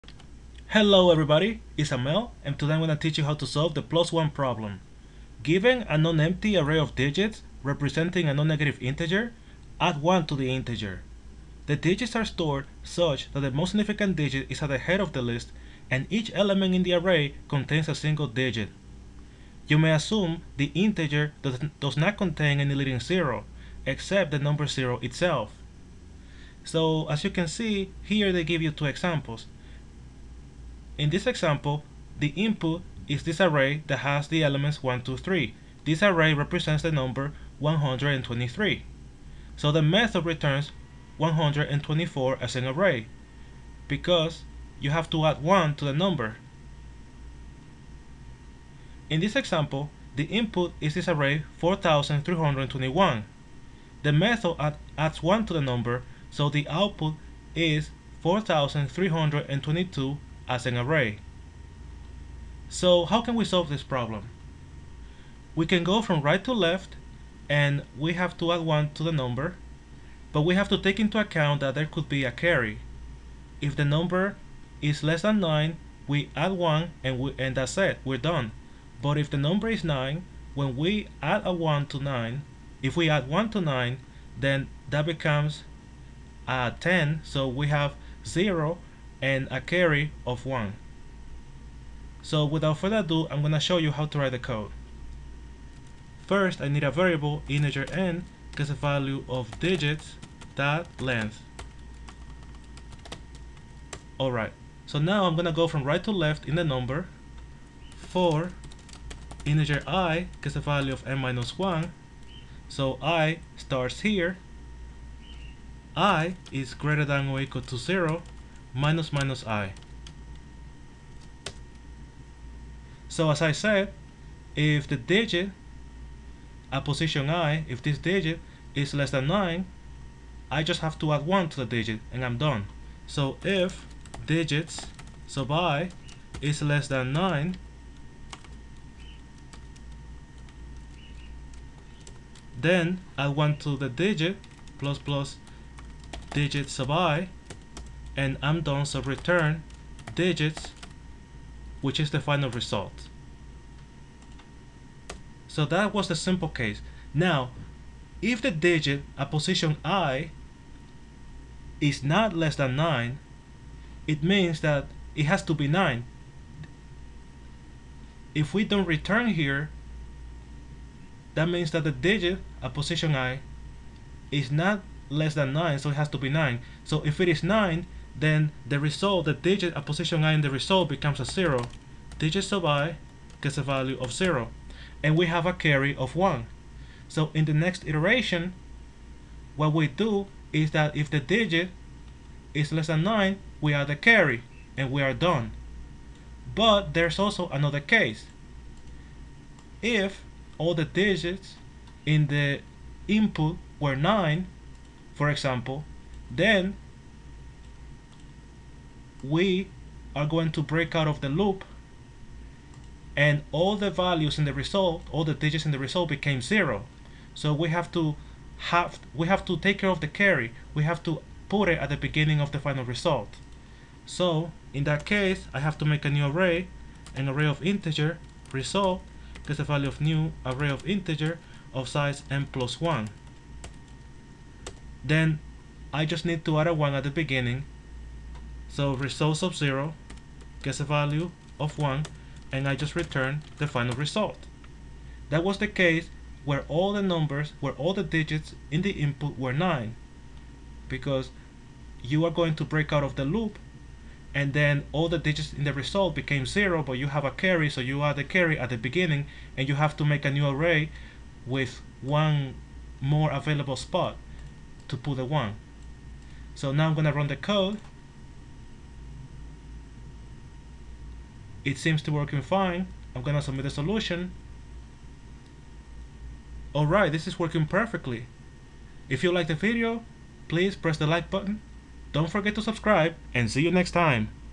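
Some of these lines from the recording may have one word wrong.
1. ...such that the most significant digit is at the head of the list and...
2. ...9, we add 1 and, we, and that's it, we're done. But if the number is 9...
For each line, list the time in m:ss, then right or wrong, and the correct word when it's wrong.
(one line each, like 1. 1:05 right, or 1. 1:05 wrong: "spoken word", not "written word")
1. 0:12 right
2. 1:15 right.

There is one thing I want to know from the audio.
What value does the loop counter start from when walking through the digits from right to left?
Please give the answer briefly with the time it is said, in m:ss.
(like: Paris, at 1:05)
n minus 1, at 1:51.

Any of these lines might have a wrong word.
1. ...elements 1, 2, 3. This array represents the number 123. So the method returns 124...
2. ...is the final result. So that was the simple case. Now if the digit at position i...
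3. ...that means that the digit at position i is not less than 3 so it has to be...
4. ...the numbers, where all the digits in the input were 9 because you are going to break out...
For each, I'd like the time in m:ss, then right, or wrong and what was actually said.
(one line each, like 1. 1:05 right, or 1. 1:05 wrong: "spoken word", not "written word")
1. 0:34 right
2. 2:31 right
3. 2:51 wrong: "9", not "3"
4. 4:06 right.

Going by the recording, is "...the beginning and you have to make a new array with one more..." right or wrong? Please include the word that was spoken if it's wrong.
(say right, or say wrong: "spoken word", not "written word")
right.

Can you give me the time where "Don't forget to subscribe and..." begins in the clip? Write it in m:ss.
4:42.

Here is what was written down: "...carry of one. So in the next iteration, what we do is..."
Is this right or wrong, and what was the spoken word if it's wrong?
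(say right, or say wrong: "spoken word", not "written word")
right.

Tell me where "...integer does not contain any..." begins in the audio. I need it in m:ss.
0:20.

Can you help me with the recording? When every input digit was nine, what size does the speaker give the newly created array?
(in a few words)
n plus one.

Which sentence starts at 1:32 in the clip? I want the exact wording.
So without further ado, I'm going to show you how to write the code.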